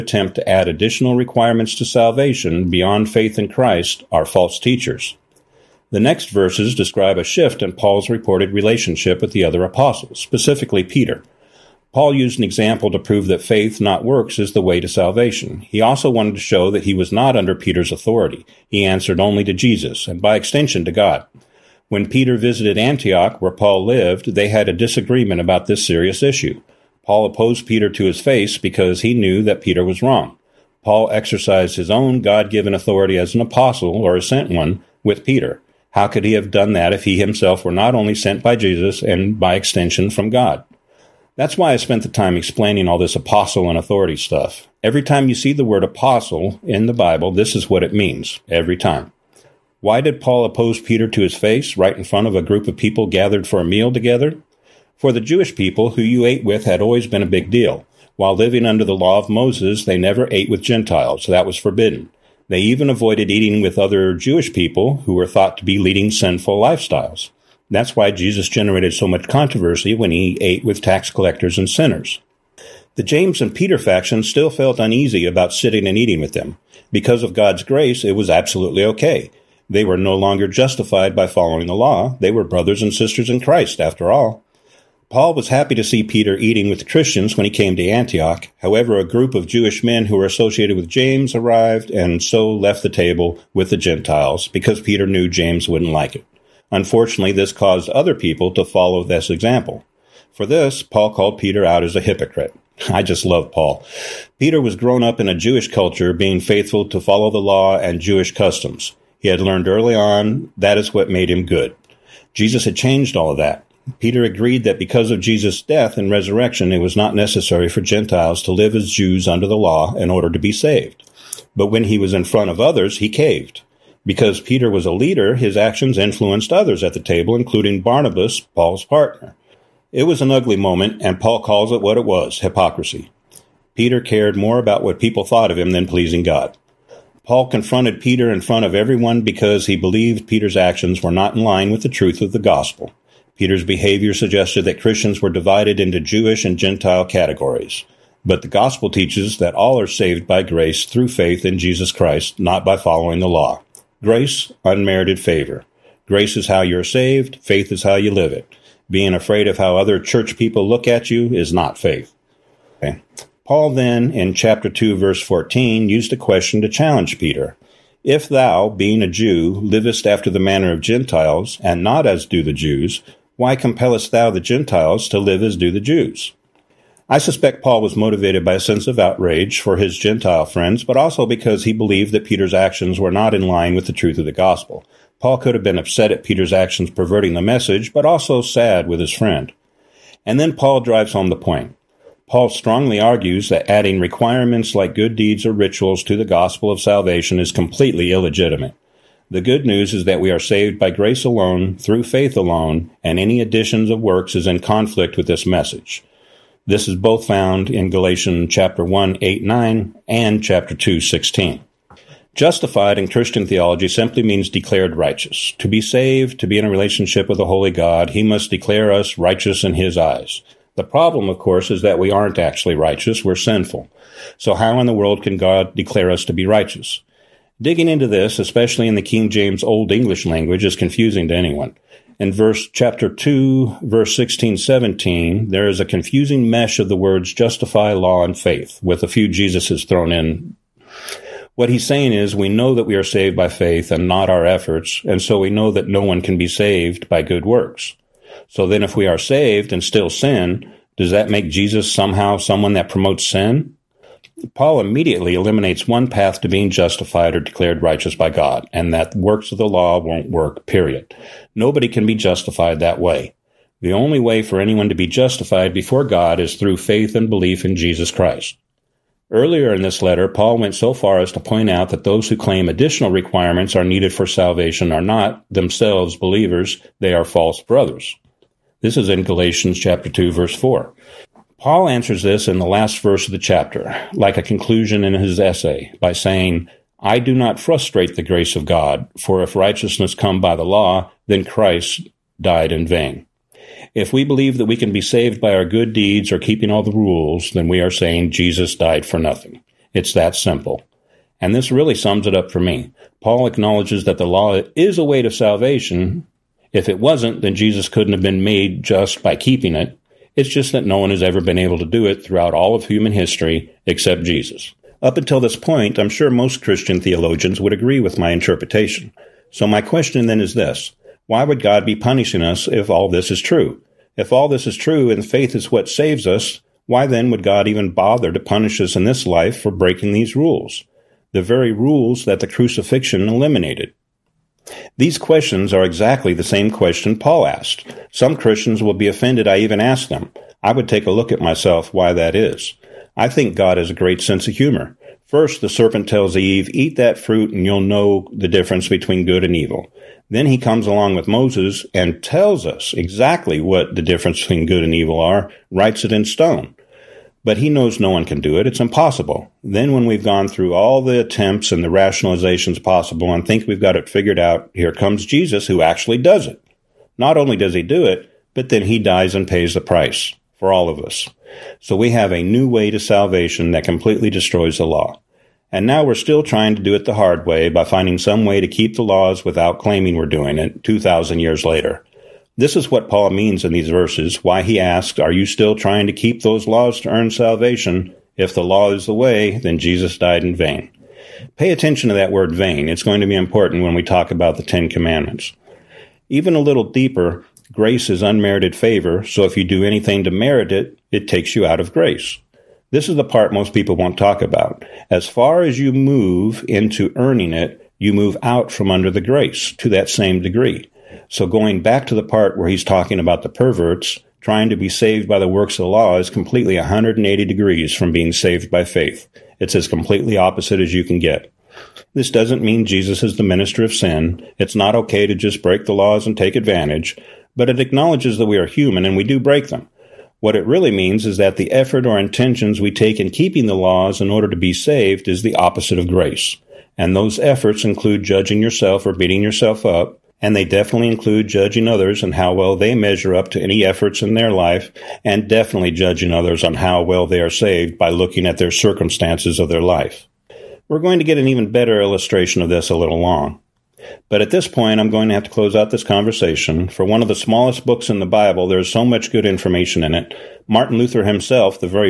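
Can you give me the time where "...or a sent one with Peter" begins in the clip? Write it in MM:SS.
00:33.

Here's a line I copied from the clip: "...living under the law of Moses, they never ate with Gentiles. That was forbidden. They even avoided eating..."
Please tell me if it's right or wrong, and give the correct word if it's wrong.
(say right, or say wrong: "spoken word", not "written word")
right.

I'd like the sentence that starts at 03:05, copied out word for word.
Paul could have been upset at Peter's actions perverting the message, but also sad with his friend.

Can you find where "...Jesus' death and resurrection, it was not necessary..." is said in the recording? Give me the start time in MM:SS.
01:55.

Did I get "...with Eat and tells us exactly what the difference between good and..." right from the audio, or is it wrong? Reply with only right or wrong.
wrong.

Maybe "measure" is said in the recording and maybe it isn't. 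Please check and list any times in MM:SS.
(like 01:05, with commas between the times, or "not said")
07:22.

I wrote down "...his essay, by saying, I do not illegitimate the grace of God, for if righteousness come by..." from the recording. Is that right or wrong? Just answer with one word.
wrong.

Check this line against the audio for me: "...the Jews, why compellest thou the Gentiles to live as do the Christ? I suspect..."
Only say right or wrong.
wrong.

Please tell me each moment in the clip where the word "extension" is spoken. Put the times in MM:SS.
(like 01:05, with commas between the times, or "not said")
00:20, 00:39.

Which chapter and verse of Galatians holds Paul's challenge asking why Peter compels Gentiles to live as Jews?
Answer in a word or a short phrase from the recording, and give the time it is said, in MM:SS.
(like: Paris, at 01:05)
Chapter 2, verse 14, at 02:44.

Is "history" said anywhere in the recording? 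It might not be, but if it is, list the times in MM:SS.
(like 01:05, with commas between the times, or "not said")
05:13.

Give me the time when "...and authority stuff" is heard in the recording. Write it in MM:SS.
00:43.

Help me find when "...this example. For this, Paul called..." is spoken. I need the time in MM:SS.
01:39.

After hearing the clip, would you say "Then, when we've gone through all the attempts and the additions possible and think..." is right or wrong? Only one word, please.
wrong.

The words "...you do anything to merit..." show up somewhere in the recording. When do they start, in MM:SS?
06:39.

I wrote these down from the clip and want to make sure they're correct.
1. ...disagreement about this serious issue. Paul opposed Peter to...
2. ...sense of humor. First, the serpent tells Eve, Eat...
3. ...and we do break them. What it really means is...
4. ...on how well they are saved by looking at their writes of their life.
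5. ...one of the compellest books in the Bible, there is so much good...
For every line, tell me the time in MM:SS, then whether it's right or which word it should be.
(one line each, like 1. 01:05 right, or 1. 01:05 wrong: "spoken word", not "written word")
1. 00:24 right
2. 05:44 right
3. 07:09 right
4. 07:26 wrong: "circumstances", not "writes"
5. 07:37 wrong: "smallest", not "compellest".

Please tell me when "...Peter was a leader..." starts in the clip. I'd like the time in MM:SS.
02:04.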